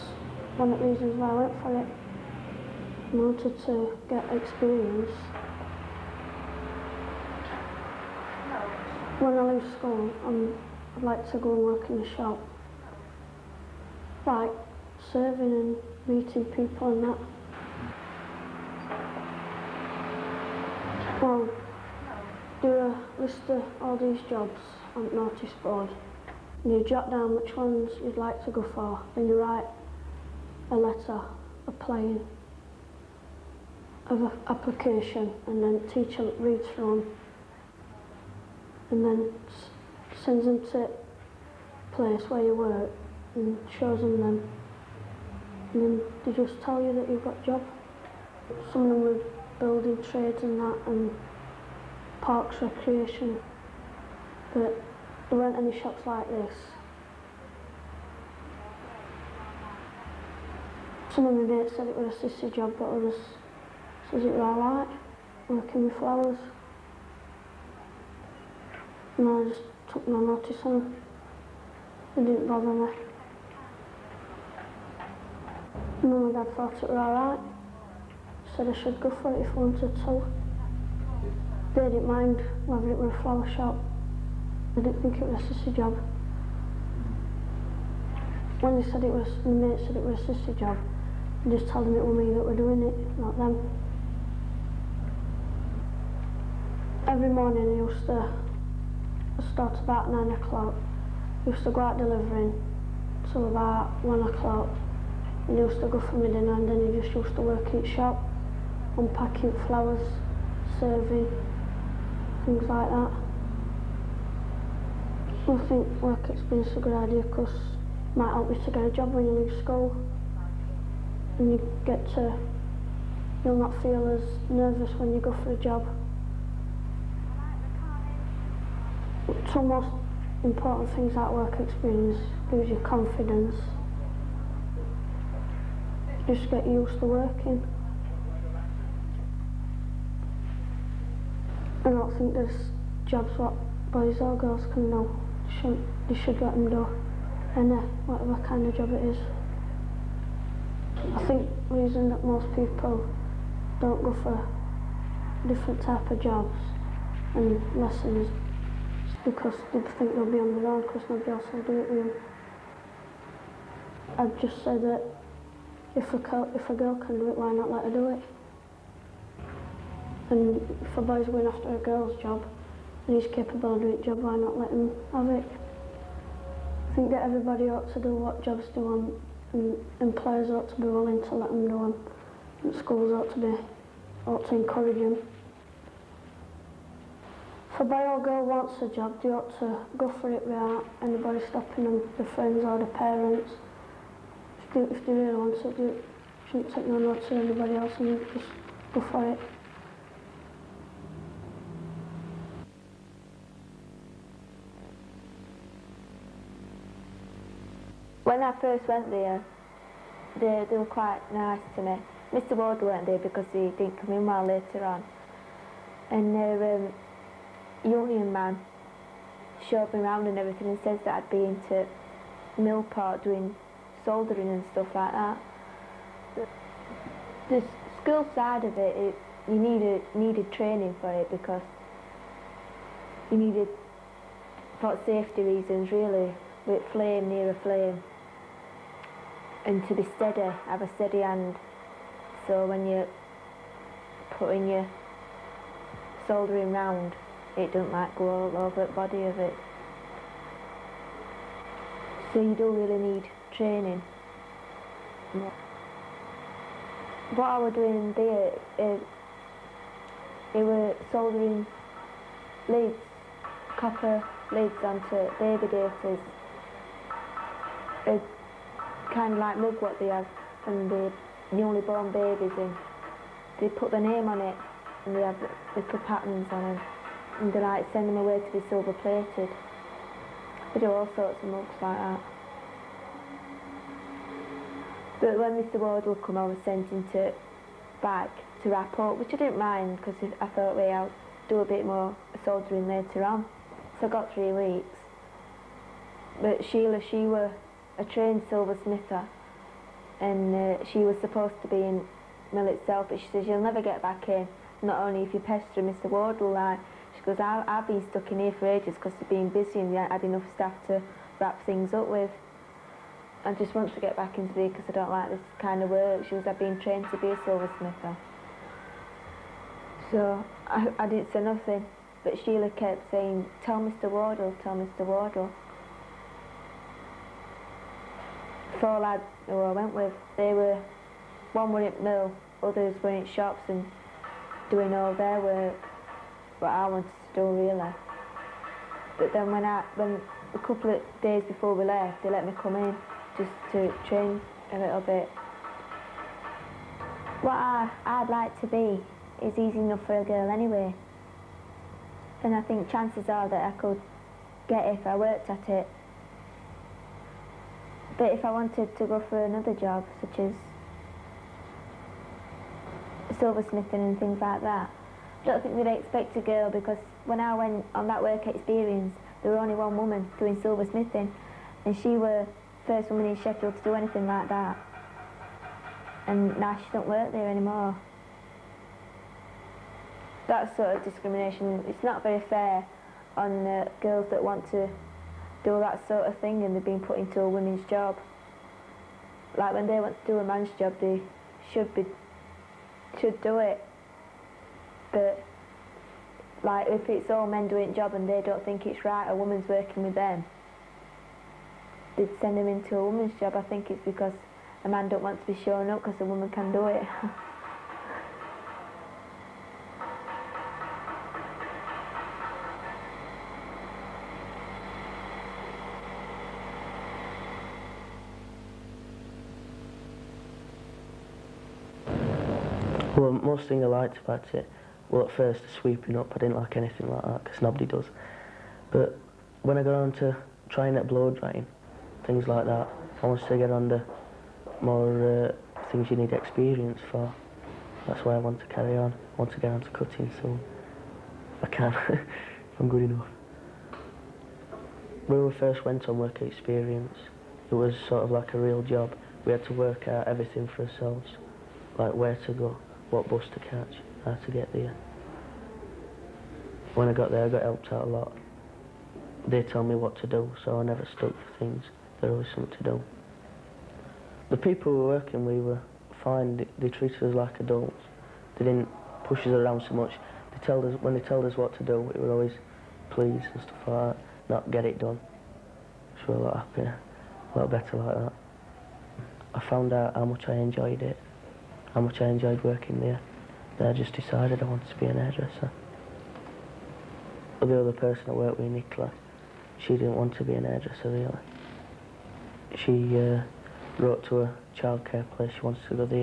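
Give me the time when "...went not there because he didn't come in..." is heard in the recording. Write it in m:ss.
3:32.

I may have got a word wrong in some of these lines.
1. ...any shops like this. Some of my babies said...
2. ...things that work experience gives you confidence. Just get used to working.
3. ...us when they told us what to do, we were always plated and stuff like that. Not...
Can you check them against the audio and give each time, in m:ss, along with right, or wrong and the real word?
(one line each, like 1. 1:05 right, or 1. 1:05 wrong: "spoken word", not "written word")
1. 0:55 wrong: "mates", not "babies"
2. 2:10 right
3. 7:50 wrong: "pleased", not "plated".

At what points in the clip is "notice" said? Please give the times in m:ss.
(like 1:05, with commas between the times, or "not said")
0:25, 1:10, 3:16.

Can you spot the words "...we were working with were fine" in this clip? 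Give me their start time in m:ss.
7:44.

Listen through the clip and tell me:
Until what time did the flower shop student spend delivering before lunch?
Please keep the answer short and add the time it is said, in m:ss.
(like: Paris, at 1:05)
1 o'clock, at 1:44.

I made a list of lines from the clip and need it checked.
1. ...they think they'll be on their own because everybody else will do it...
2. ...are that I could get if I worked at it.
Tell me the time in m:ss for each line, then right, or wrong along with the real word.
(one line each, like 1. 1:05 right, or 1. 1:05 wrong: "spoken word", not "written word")
1. 2:39 wrong: "nobody", not "everybody"
2. 5:53 right.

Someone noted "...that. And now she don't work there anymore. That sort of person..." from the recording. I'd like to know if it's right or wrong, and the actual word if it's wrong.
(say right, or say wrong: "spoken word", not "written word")
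wrong: "discrimination", not "person".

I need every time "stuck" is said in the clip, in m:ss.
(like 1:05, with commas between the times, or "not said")
5:08, 7:41.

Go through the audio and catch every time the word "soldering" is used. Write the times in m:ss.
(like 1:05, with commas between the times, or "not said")
3:44, 4:06, 4:21, 4:52.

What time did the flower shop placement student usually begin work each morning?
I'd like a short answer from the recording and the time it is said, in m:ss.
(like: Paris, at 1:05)
9 o'clock, at 1:40.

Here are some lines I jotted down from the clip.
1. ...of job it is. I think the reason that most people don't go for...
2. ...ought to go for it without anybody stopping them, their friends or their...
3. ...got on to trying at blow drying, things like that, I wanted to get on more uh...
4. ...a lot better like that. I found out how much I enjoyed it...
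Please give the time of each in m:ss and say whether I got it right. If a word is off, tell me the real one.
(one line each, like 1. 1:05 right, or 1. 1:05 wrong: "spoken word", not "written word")
1. 2:28 right
2. 3:09 right
3. 7:09 right
4. 7:57 right.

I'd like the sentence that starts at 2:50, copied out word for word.
And for boys going after a girl's job, and he's capable of doing a job, why not let him have it?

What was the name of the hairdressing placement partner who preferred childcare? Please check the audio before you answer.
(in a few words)
Nicola.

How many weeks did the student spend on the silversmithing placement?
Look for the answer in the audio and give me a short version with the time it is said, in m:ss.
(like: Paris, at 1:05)
3, at 4:54.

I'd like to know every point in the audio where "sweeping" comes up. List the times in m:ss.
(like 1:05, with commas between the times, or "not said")
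7:05.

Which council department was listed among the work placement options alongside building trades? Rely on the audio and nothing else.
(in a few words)
Parks Recreation.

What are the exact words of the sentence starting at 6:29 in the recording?
Like when they want to do a man's job, they should be should do it.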